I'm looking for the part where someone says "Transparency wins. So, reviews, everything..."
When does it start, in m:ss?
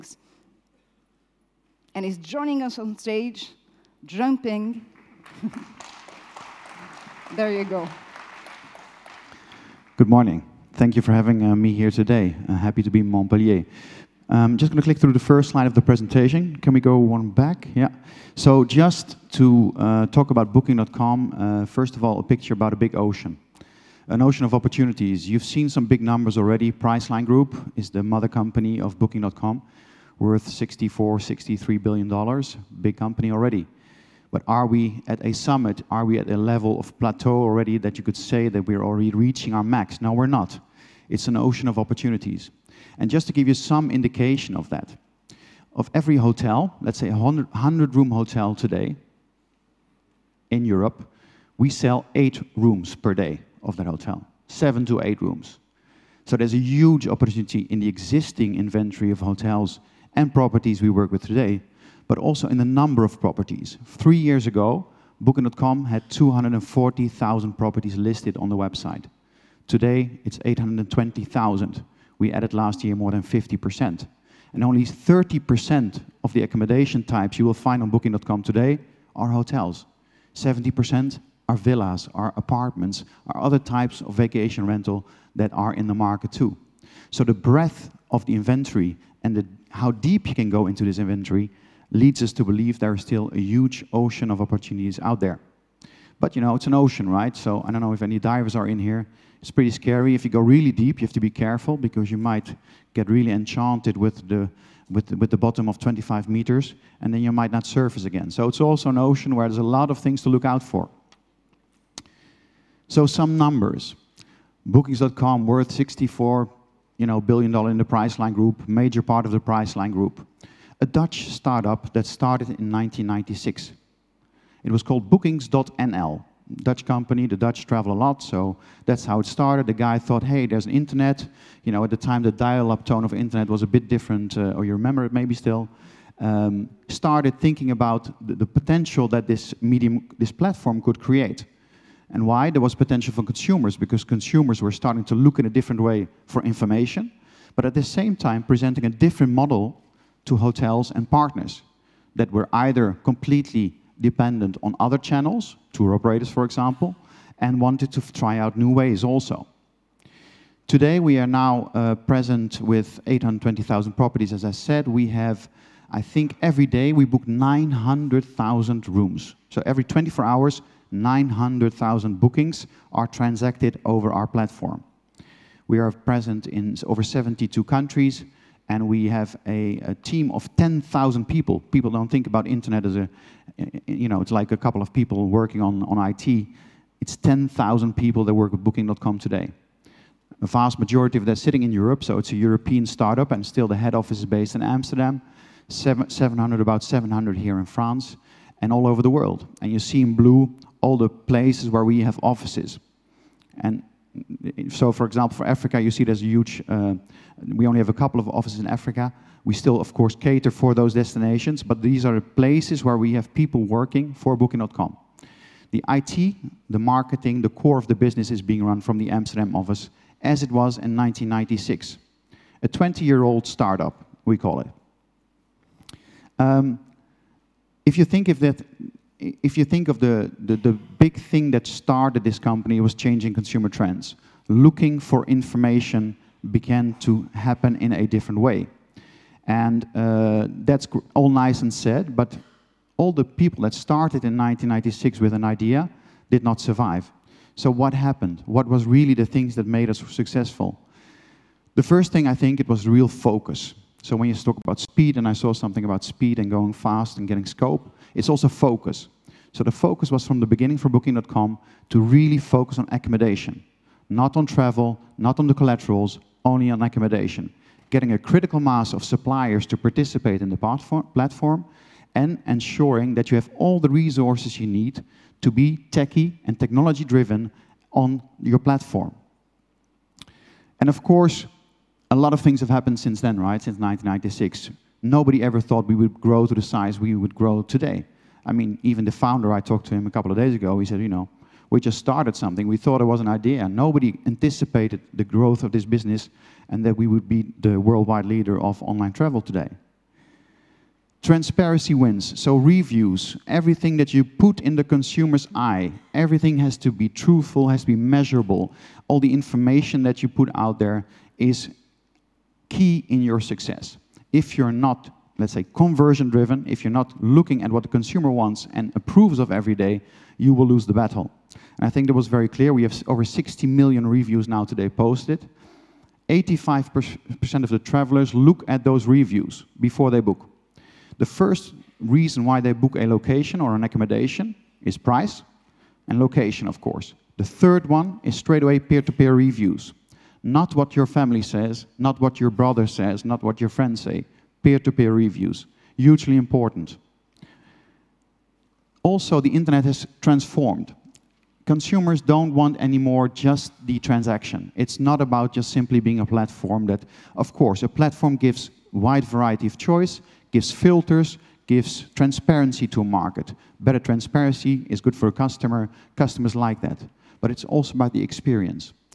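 5:01.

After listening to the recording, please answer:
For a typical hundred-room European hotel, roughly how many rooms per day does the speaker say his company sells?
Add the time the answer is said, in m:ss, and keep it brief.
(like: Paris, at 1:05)
7 to 8, at 0:54.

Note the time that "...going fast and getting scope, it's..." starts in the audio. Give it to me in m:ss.
4:16.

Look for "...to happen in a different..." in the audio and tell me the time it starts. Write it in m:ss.
3:56.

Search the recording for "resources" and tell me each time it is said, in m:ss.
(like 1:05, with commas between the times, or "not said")
4:33.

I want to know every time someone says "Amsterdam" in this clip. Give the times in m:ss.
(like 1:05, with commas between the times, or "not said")
3:14, 3:39.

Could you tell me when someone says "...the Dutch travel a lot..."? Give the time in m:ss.
2:07.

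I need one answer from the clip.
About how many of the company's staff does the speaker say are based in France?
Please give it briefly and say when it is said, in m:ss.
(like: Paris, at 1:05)
700, at 3:16.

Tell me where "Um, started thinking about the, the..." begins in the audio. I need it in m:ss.
2:16.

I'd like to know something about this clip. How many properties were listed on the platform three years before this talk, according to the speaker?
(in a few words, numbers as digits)
240,000.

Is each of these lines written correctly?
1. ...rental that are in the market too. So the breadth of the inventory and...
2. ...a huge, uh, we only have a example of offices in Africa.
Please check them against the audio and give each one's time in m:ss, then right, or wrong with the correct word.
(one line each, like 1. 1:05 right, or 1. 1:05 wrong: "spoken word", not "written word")
1. 1:24 right
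2. 3:26 wrong: "couple", not "example".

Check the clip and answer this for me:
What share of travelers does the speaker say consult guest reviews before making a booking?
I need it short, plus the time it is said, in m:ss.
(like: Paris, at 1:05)
85%, at 5:26.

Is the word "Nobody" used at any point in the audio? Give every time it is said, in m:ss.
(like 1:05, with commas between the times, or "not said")
4:45, 4:53.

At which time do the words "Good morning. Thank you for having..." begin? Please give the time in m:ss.
0:09.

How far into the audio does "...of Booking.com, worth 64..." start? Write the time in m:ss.
0:28.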